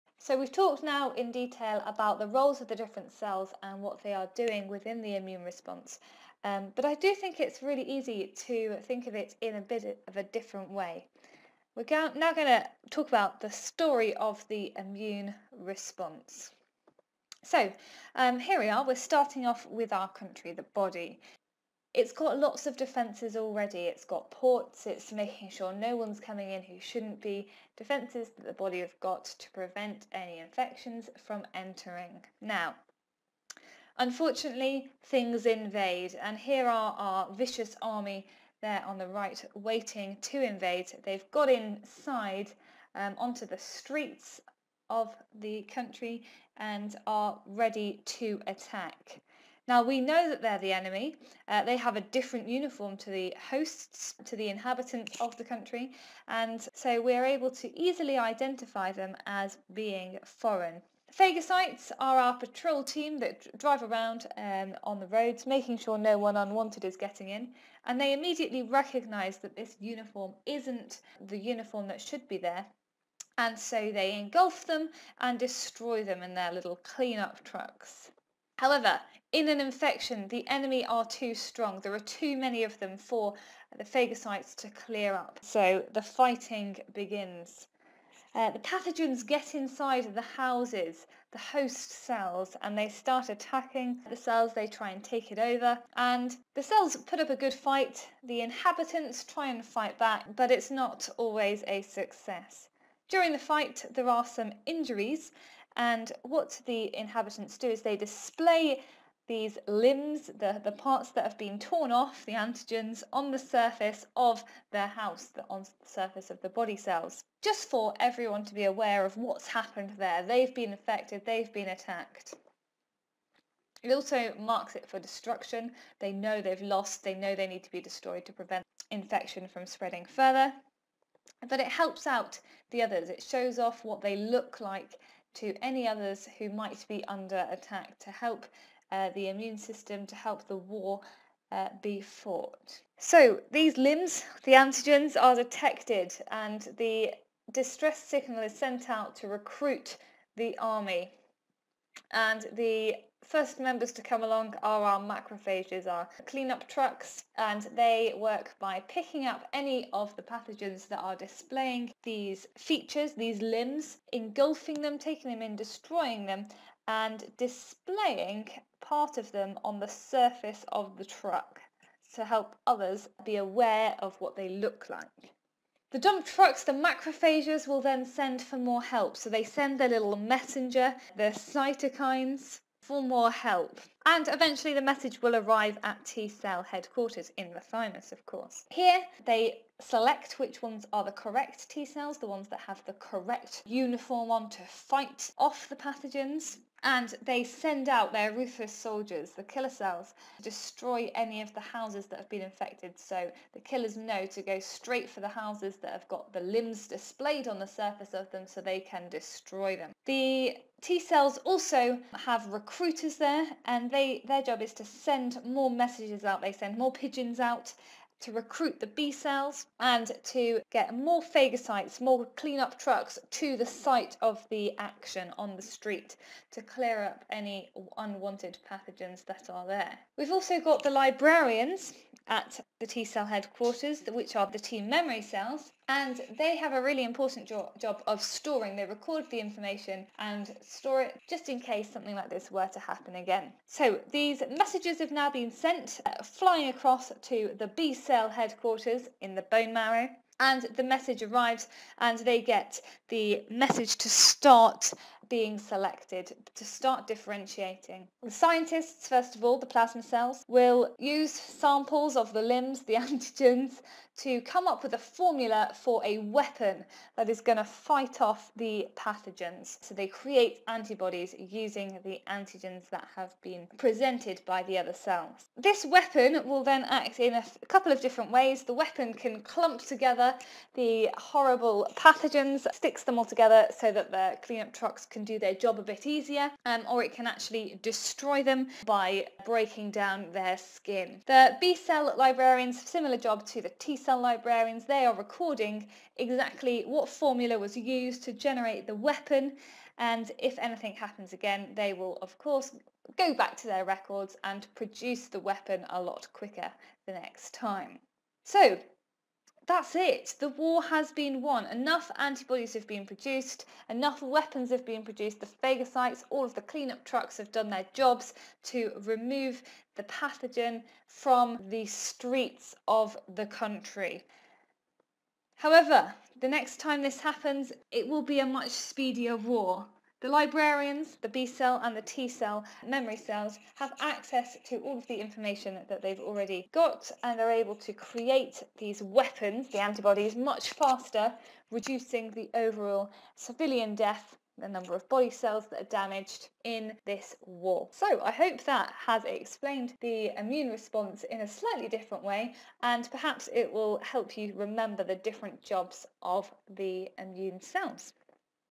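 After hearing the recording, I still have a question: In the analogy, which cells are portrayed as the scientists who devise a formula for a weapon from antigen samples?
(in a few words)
plasma cells.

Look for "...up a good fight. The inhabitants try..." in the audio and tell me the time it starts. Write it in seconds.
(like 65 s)
97 s.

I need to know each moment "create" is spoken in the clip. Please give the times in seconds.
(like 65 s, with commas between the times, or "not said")
270 s, 337 s.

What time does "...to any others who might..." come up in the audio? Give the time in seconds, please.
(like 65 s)
135 s.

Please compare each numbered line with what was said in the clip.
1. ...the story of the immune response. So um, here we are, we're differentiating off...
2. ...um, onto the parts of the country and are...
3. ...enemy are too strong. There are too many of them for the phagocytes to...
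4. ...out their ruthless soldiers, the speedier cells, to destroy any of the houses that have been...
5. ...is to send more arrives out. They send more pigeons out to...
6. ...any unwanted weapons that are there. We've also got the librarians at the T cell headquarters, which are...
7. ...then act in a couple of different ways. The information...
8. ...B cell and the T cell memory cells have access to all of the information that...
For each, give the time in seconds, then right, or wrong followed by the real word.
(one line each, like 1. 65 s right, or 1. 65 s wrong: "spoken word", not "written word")
1. 13 s wrong: "starting", not "differentiating"
2. 42 s wrong: "streets", not "parts"
3. 80 s right
4. 197 s wrong: "killer", not "speedier"
5. 214 s wrong: "messages", not "arrives"
6. 227 s wrong: "pathogens", not "weapons"
7. 276 s wrong: "weapon", not "information"
8. 331 s right.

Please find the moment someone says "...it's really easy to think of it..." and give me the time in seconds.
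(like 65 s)
7 s.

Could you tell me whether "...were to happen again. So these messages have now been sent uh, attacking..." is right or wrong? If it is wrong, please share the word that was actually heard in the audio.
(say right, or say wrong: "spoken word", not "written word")
wrong: "flying", not "attacking".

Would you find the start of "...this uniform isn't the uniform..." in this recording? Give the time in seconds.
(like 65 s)
69 s.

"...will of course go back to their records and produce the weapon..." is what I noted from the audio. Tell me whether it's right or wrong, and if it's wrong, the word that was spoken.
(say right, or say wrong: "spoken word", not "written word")
right.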